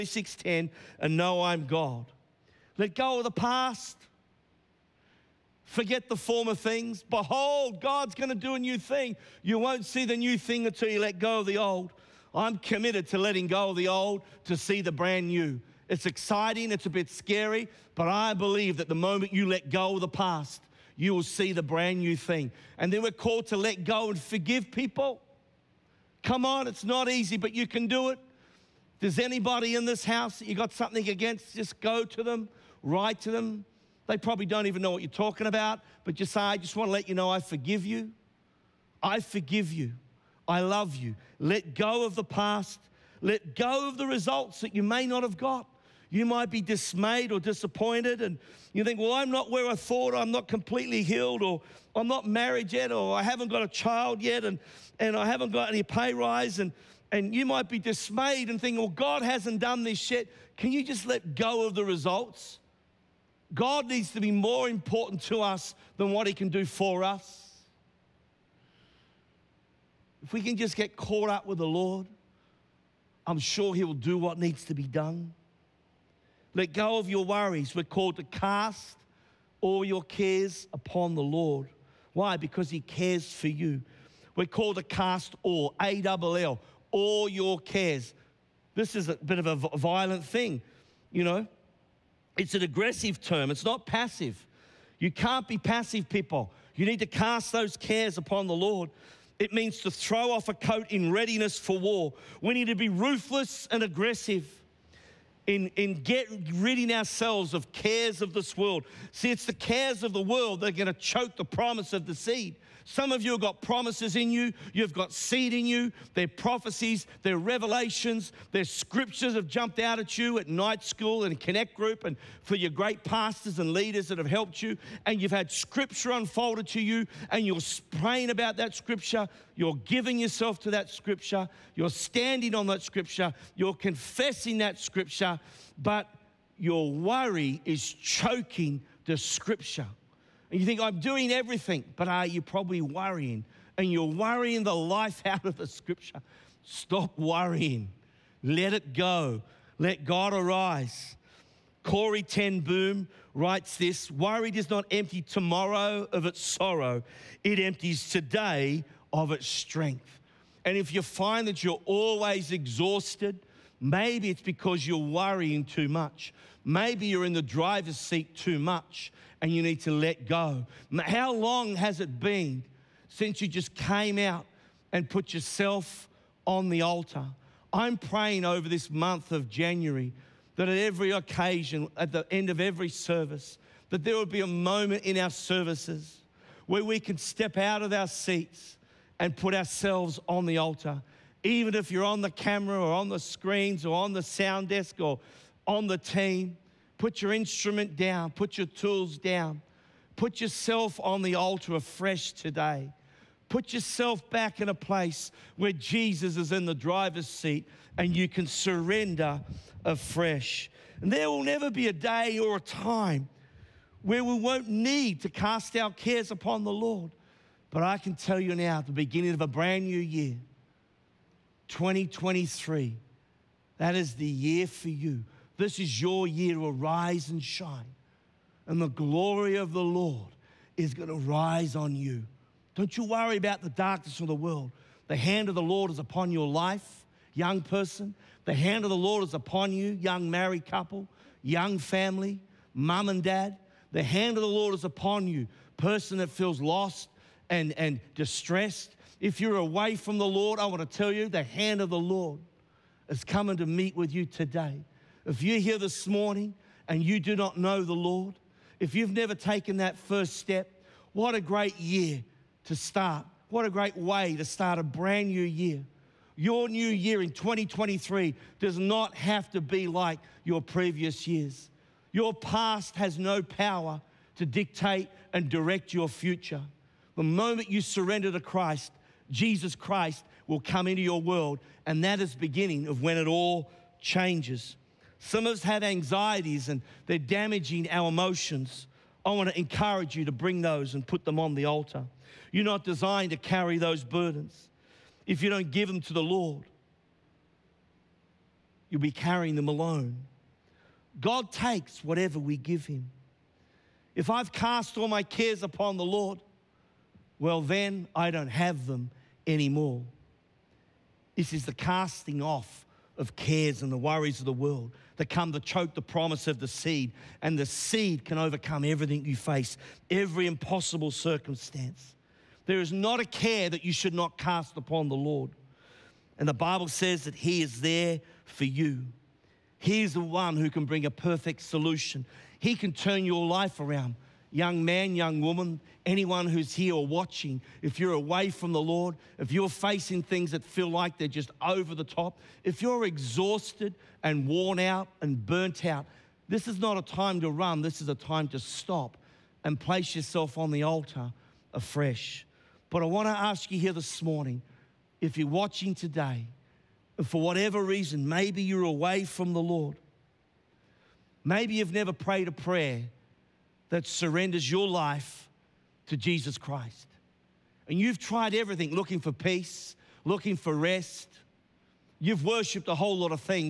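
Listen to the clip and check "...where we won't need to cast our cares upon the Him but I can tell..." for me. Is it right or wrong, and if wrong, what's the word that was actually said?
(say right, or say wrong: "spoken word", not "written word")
wrong: "Lord", not "Him".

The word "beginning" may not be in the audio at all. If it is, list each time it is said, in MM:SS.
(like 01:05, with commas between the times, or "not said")
03:38, 04:42.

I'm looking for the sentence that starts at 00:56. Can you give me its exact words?
And, and you might be dismayed and think, Well, God hasn't done this yet.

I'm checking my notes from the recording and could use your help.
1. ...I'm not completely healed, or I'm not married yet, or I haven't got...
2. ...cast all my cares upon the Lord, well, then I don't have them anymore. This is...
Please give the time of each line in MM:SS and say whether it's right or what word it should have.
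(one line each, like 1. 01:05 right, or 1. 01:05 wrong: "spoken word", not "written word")
1. 00:50 right
2. 05:04 right.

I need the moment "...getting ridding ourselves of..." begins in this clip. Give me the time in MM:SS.
01:46.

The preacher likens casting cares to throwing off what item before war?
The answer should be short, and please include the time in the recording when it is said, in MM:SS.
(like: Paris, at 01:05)
A coat, at 01:40.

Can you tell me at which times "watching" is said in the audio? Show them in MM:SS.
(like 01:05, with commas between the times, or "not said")
05:37, 05:55.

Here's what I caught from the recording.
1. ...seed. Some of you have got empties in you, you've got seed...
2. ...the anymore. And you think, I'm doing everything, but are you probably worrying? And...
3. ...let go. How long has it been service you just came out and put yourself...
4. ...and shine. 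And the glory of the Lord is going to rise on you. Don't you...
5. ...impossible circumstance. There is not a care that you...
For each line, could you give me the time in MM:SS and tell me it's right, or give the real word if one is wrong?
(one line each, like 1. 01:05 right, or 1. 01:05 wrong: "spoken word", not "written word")
1. 01:52 wrong: "promises", not "empties"
2. 02:19 wrong: "scripture", not "anymore"
3. 02:49 wrong: "since", not "service"
4. 03:47 right
5. 05:20 right.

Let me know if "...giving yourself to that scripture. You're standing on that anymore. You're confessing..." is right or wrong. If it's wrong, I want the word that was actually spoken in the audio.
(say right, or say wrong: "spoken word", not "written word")
wrong: "scripture", not "anymore".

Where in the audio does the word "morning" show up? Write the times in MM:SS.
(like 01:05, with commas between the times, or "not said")
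04:16, 05:54.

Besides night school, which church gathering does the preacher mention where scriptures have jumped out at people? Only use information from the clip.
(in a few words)
Connect group.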